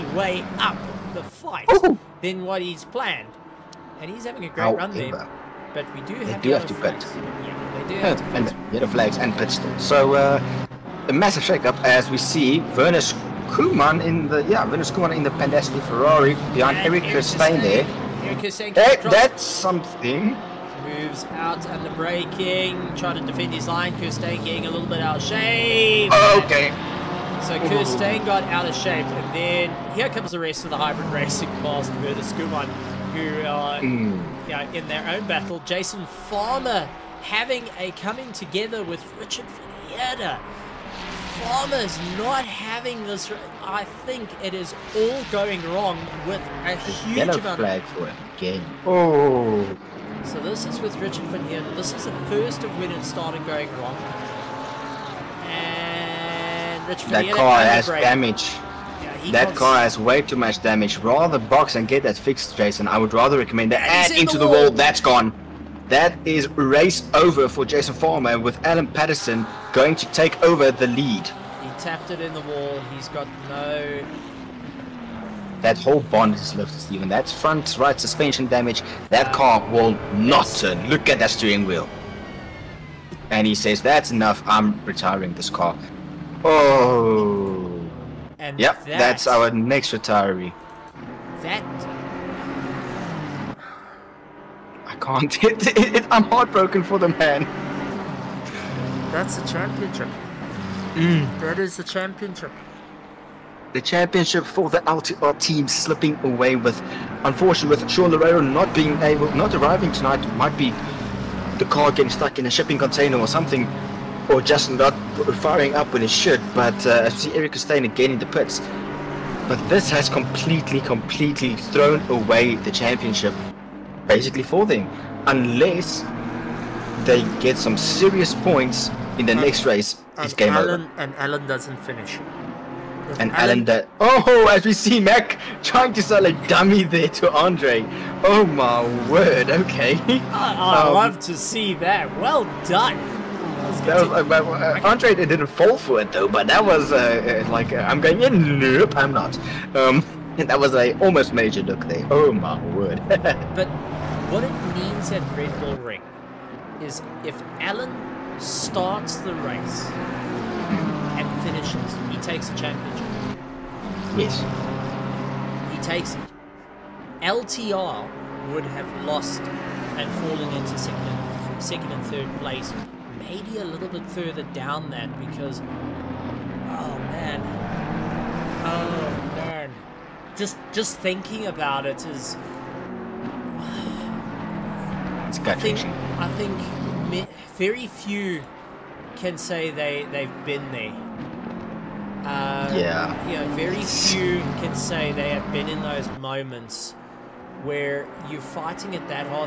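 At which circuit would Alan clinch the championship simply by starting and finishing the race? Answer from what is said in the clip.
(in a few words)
Red Bull Ring.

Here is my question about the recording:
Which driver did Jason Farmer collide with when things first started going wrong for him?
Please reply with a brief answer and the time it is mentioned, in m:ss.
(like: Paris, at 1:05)
Richard Vinieta, at 0:39.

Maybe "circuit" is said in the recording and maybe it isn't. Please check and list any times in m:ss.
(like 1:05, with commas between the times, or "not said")
not said.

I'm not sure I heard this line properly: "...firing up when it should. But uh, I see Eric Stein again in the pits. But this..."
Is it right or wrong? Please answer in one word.
right.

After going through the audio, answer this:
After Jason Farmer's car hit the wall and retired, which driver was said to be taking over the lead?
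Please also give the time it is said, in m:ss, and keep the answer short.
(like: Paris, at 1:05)
Alan Patterson, at 1:08.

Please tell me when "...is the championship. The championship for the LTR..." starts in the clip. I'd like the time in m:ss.
1:41.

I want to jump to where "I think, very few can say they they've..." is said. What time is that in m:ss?
3:06.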